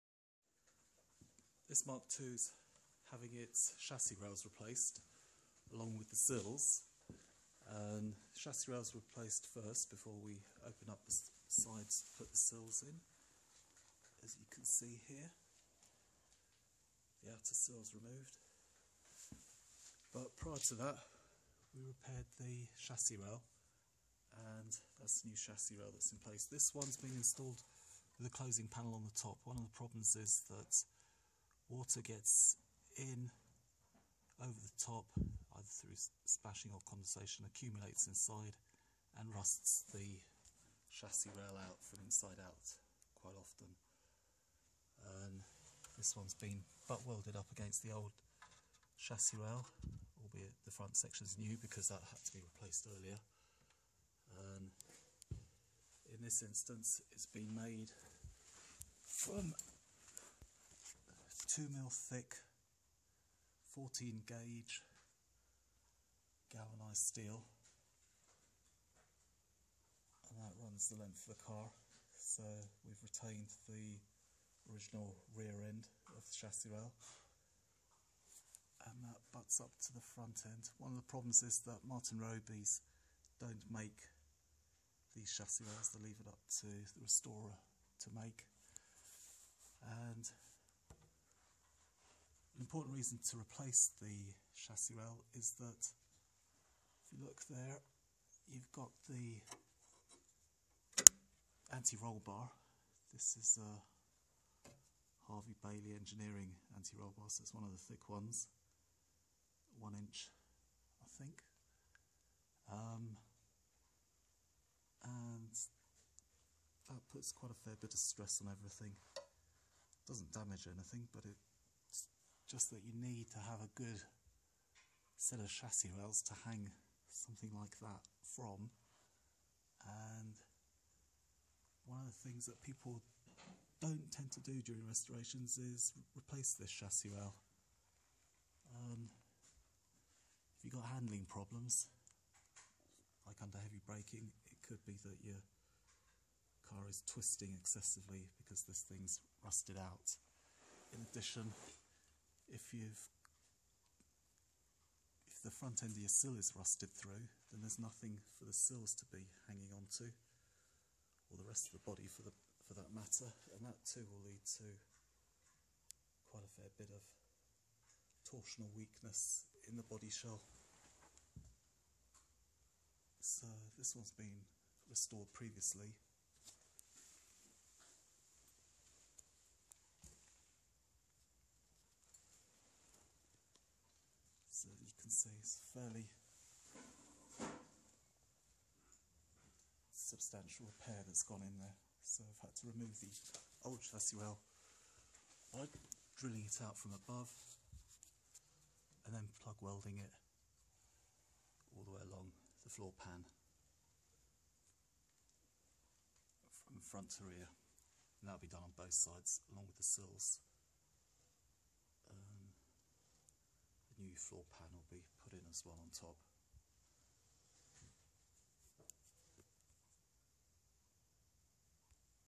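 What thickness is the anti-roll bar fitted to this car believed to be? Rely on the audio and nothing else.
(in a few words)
1 inch.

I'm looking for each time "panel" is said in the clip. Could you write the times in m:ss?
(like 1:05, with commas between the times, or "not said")
0:28, 3:34.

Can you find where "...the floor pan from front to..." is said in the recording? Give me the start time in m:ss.
3:22.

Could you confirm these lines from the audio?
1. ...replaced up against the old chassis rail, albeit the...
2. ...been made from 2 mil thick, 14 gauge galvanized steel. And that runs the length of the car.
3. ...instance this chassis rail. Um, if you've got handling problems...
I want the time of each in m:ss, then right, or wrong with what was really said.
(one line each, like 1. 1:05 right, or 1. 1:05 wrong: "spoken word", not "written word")
1. 0:47 wrong: "welded", not "replaced"
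2. 0:57 right
3. 2:16 wrong: "replace", not "instance".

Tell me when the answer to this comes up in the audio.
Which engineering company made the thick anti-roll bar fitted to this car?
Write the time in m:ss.
1:45.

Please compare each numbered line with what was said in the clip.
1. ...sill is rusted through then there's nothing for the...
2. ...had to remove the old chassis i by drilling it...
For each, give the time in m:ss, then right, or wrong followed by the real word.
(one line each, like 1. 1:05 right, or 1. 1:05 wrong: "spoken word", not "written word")
1. 2:36 right
2. 3:12 right.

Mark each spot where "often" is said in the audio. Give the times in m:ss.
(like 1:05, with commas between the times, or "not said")
0:43.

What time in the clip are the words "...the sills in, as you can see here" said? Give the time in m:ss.
0:12.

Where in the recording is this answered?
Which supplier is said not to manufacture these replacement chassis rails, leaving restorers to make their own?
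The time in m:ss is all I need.
1:21.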